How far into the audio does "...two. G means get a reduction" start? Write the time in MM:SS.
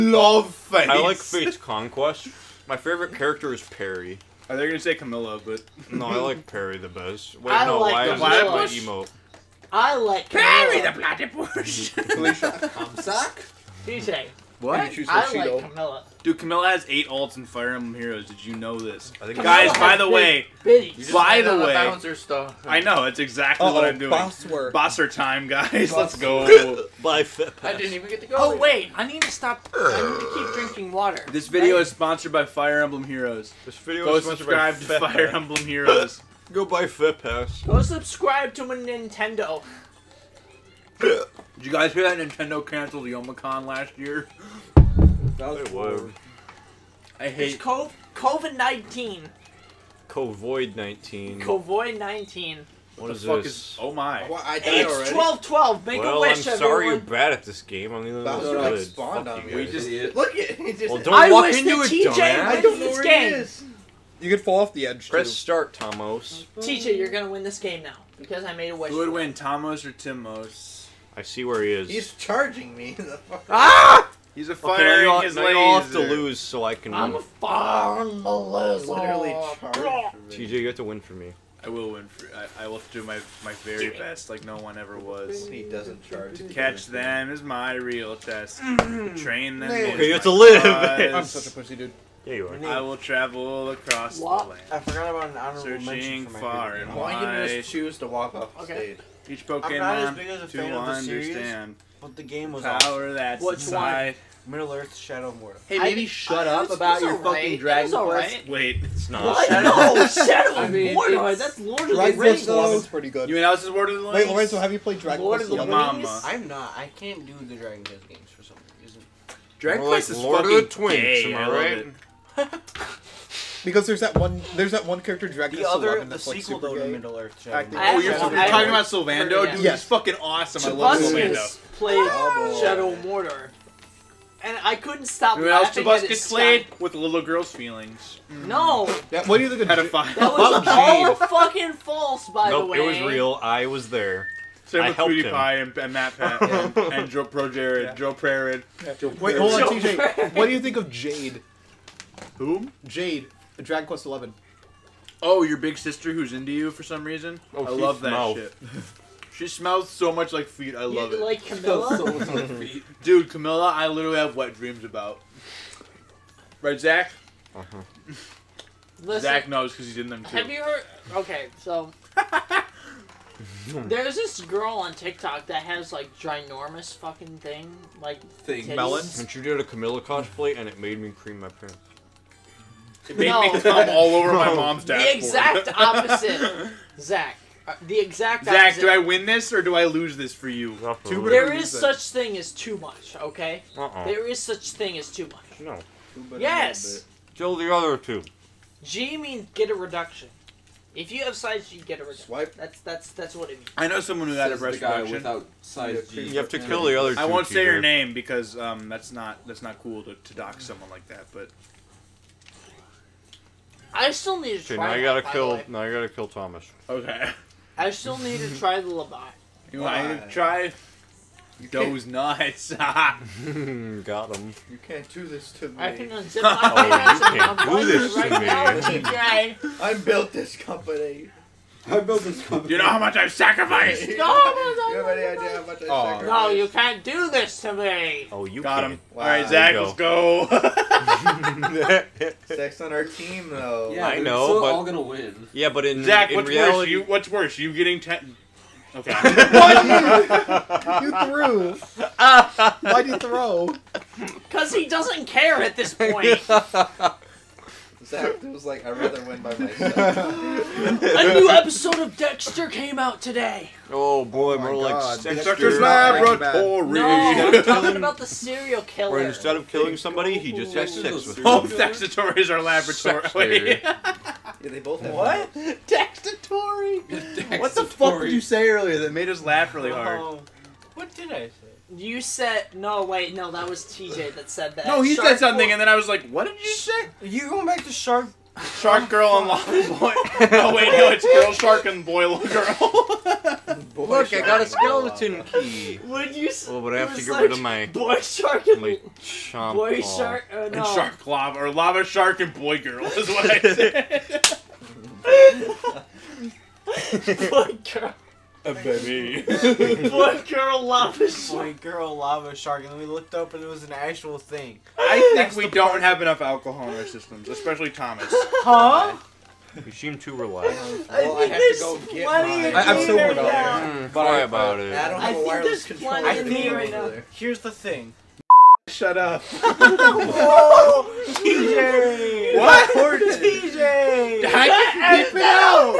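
03:17.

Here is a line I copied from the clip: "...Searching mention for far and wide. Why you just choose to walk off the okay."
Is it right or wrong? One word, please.
right.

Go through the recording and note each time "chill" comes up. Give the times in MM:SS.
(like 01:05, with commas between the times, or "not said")
not said.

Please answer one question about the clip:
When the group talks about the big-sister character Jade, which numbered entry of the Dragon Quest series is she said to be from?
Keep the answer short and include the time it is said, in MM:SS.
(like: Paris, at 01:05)
Dragon Quest 11, at 02:33.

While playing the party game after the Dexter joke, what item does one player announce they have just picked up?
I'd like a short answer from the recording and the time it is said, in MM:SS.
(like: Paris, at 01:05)
Skeleton key, at 04:54.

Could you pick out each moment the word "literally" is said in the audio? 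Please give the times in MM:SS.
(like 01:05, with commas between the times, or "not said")
01:18, 02:43.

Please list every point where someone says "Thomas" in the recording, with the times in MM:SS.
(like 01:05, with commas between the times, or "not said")
03:36, 05:17.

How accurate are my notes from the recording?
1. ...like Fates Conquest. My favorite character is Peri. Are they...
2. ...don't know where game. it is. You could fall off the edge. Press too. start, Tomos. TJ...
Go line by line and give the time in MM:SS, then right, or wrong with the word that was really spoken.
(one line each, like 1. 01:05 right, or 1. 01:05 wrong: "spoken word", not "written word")
1. 00:01 right
2. 01:02 right.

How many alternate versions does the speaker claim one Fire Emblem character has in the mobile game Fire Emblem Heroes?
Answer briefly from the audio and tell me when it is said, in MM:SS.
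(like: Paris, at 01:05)
8, at 00:16.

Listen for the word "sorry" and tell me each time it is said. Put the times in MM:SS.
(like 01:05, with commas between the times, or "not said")
00:56, 05:24.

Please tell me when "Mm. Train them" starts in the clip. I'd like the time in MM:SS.
01:28.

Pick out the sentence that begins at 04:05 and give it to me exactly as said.
Yeah, but in Zach, in what's worse?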